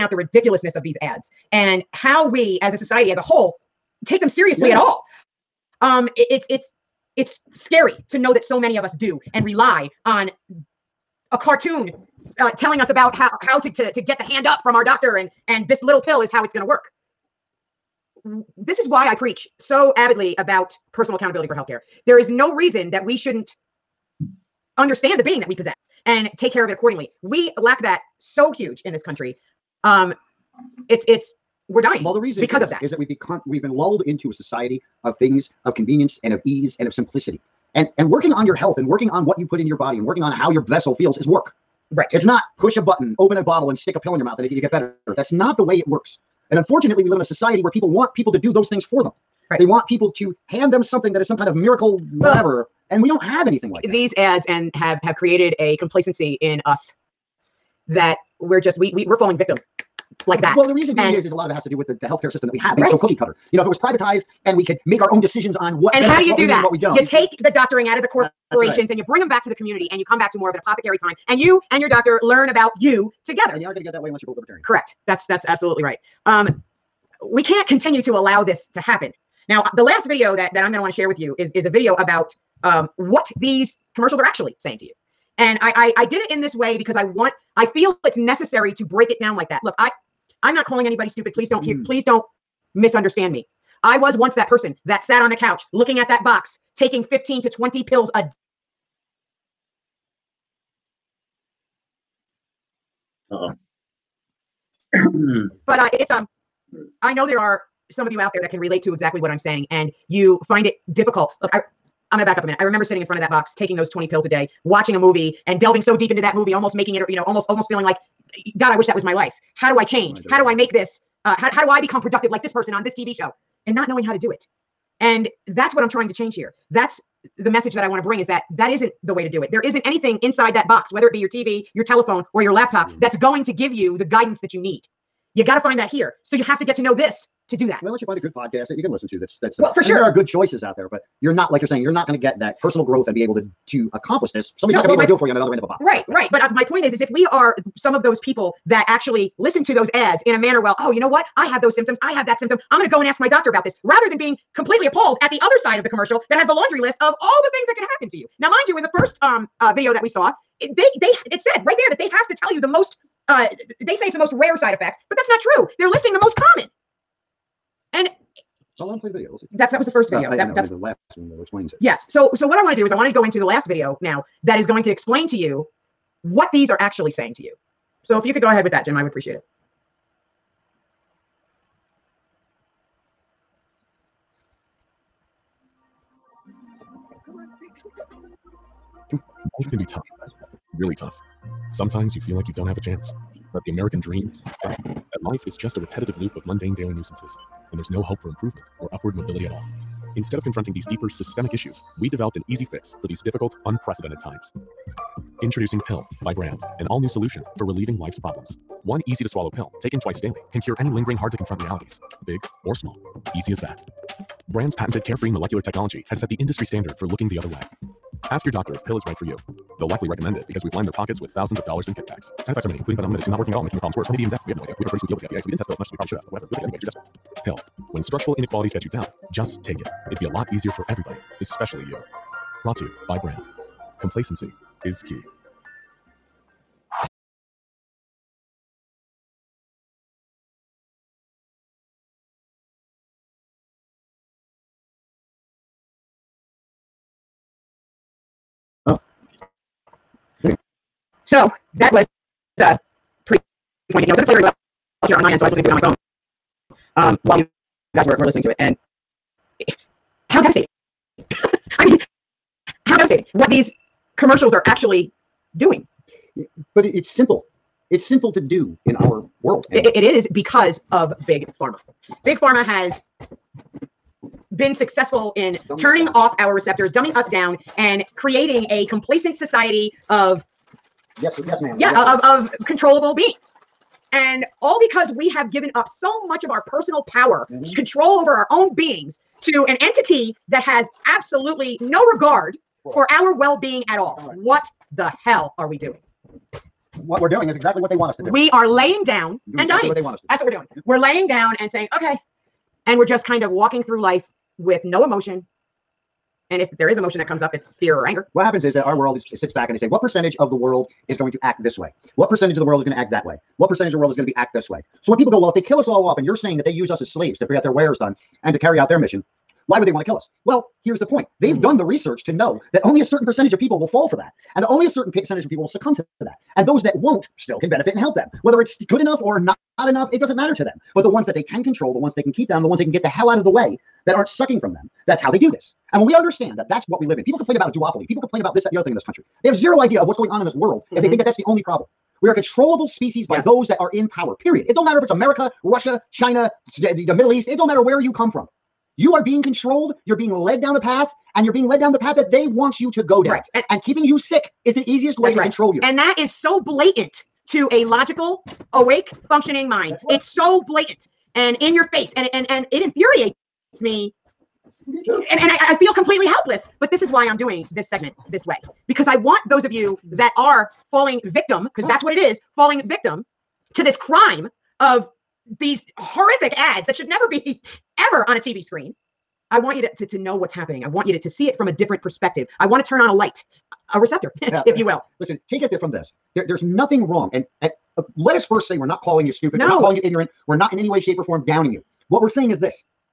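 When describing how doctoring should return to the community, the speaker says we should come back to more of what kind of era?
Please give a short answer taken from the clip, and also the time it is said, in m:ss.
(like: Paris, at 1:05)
apothecary time, at 1:10.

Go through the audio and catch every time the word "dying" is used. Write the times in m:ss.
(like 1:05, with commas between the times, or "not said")
0:31, 4:59.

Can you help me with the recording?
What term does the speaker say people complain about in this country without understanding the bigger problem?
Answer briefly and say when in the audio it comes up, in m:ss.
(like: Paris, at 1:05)
duopoly, at 5:37.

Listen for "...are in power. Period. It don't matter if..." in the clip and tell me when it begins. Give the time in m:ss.
5:43.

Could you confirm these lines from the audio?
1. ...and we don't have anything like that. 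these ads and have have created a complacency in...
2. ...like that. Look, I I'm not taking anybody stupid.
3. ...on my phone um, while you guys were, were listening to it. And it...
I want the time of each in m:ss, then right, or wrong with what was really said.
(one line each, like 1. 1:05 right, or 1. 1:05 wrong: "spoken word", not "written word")
1. 0:52 right
2. 1:29 wrong: "calling", not "taking"
3. 4:15 right.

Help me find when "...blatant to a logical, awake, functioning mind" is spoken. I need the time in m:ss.
5:56.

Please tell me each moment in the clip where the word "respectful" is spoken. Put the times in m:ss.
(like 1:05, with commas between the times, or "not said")
not said.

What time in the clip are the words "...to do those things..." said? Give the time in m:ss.
0:48.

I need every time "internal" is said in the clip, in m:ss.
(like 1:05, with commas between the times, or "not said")
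not said.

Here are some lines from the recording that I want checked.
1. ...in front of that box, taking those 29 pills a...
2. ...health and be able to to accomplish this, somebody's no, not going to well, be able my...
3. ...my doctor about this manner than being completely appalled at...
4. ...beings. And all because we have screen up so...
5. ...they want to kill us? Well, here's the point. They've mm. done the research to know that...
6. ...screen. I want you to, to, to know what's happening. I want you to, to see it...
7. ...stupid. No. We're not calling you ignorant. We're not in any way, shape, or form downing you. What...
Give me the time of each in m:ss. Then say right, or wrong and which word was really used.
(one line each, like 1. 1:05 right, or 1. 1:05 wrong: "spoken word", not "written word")
1. 1:53 wrong: "20", not "29"
2. 2:22 wrong: "growth", not "health"
3. 2:33 wrong: "rather", not "manner"
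4. 4:43 wrong: "given", not "screen"
5. 5:19 right
6. 6:18 right
7. 6:29 right.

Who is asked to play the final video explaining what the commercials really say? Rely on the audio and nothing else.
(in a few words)
Jim.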